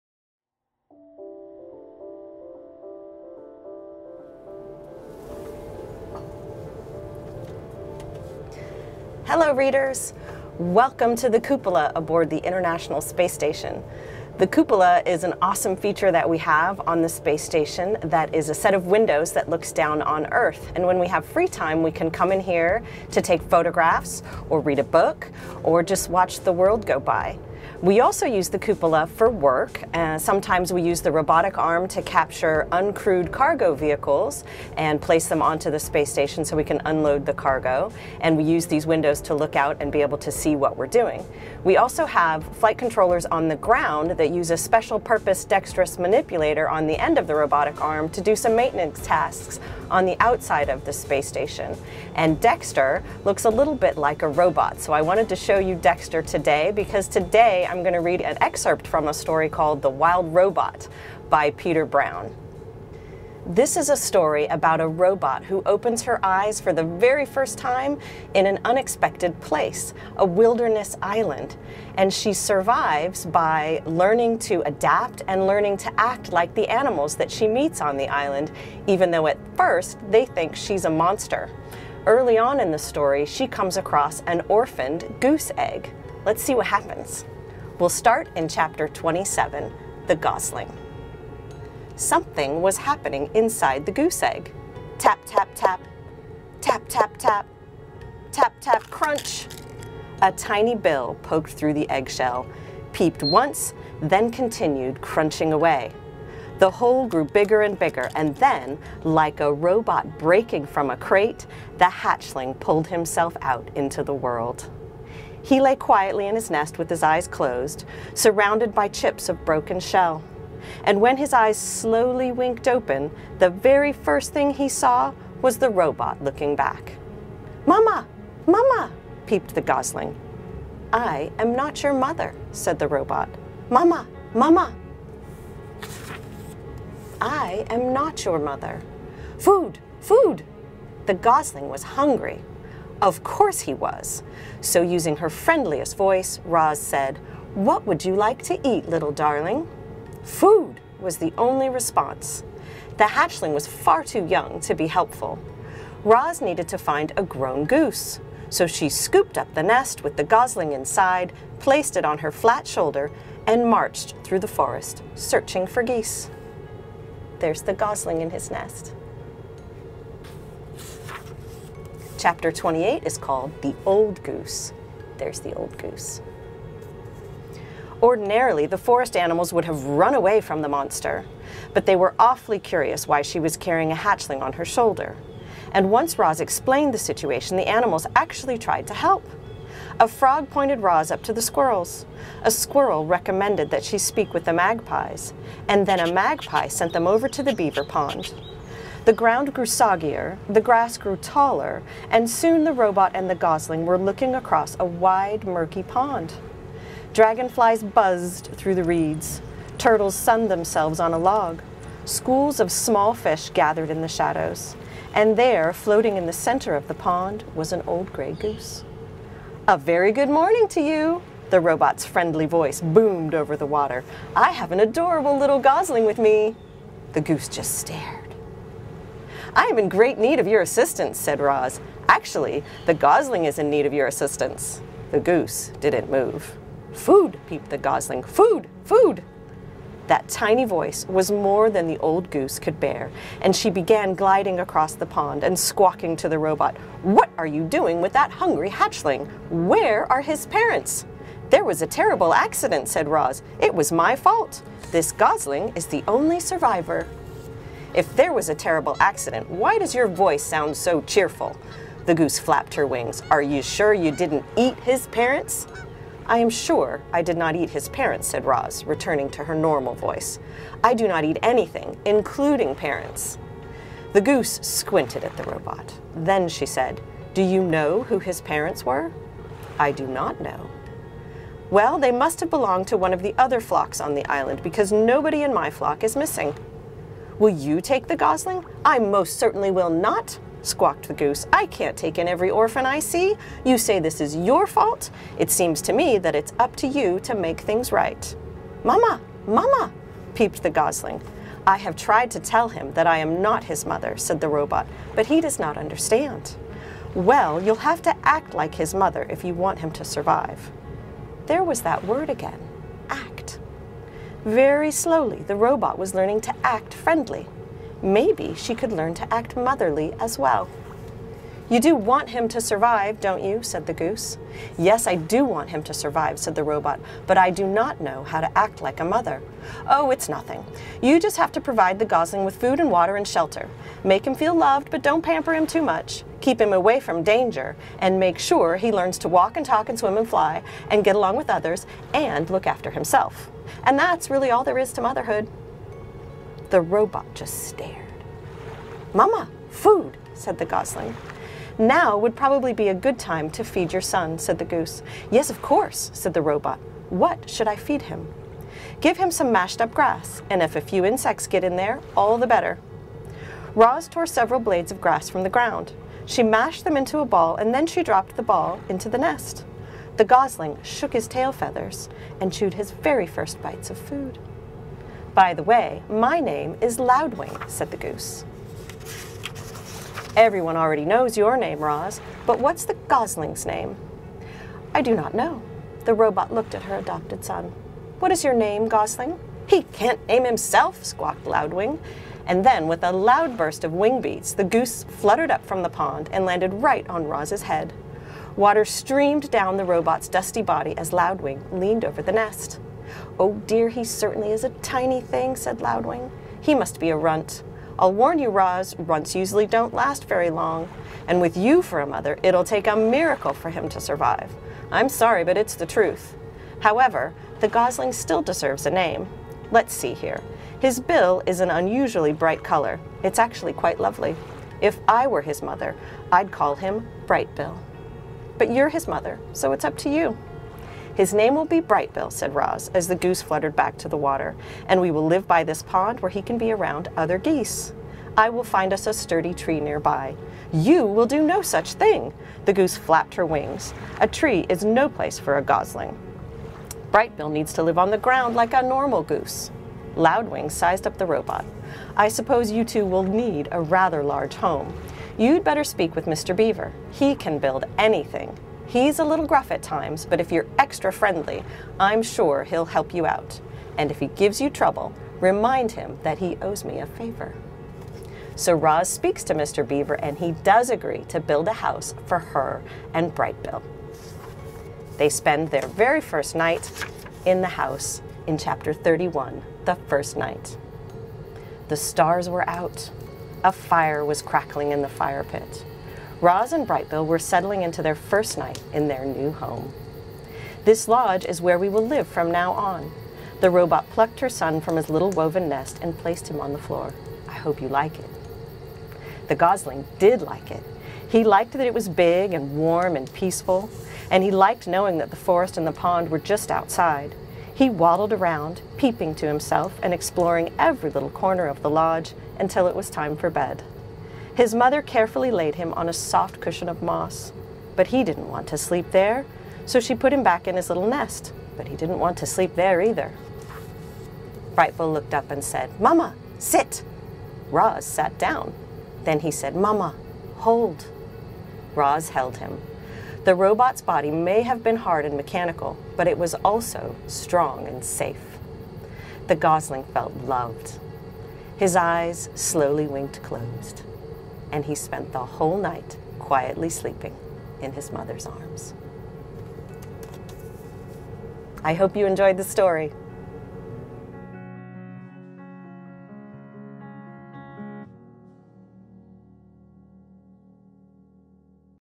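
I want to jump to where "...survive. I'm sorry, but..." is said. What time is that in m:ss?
6:54.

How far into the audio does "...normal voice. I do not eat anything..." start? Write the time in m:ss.
4:29.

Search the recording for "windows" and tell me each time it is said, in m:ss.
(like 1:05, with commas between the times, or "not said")
0:18, 0:38.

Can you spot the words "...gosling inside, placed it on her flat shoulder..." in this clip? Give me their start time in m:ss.
2:40.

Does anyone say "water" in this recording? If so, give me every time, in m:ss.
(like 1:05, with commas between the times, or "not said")
3:43, 5:32, 6:38, 7:14.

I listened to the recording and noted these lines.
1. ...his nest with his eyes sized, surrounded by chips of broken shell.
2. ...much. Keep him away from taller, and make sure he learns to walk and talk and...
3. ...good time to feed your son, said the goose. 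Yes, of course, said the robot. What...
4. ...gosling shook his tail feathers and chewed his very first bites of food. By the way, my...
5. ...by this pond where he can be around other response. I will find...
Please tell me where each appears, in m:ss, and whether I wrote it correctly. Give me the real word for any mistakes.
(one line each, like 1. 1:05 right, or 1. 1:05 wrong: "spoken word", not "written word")
1. 1:56 wrong: "closed", not "sized"
2. 5:35 wrong: "danger", not "taller"
3. 5:52 right
4. 6:10 right
5. 7:15 wrong: "geese", not "response".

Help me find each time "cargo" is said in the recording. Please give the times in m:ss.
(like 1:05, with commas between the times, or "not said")
0:33, 0:37.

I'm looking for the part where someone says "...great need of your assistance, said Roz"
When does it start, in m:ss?
3:49.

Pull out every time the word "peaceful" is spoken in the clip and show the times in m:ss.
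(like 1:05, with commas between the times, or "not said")
8:23.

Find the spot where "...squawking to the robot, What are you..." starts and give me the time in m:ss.
4:05.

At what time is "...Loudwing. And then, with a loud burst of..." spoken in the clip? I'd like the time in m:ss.
6:31.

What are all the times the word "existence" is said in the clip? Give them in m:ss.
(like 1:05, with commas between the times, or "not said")
not said.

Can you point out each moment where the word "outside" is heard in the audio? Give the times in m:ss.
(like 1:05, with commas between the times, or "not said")
0:50, 8:26.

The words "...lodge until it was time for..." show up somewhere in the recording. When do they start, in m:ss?
8:31.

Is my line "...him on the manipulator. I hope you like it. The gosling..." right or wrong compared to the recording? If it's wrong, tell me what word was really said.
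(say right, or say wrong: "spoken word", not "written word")
wrong: "floor", not "manipulator".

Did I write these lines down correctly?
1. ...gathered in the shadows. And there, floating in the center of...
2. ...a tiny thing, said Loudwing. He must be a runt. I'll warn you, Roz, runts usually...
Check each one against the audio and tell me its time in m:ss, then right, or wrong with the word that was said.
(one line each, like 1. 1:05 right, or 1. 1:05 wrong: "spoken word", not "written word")
1. 3:33 right
2. 6:44 right.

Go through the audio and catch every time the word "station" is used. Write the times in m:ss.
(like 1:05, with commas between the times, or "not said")
0:13, 0:17, 0:36, 0:51.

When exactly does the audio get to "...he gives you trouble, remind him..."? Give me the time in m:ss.
7:44.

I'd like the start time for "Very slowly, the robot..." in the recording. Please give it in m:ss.
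5:14.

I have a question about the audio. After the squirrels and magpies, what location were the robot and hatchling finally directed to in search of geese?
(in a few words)
The beaver pond.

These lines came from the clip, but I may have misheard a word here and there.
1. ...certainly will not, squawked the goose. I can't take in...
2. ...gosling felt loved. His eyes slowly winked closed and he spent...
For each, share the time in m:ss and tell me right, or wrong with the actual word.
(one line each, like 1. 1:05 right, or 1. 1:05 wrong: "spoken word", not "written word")
1. 4:49 right
2. 8:59 right.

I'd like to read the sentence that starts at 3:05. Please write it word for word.
And once Roz explained the situation, the animals actually tried to help.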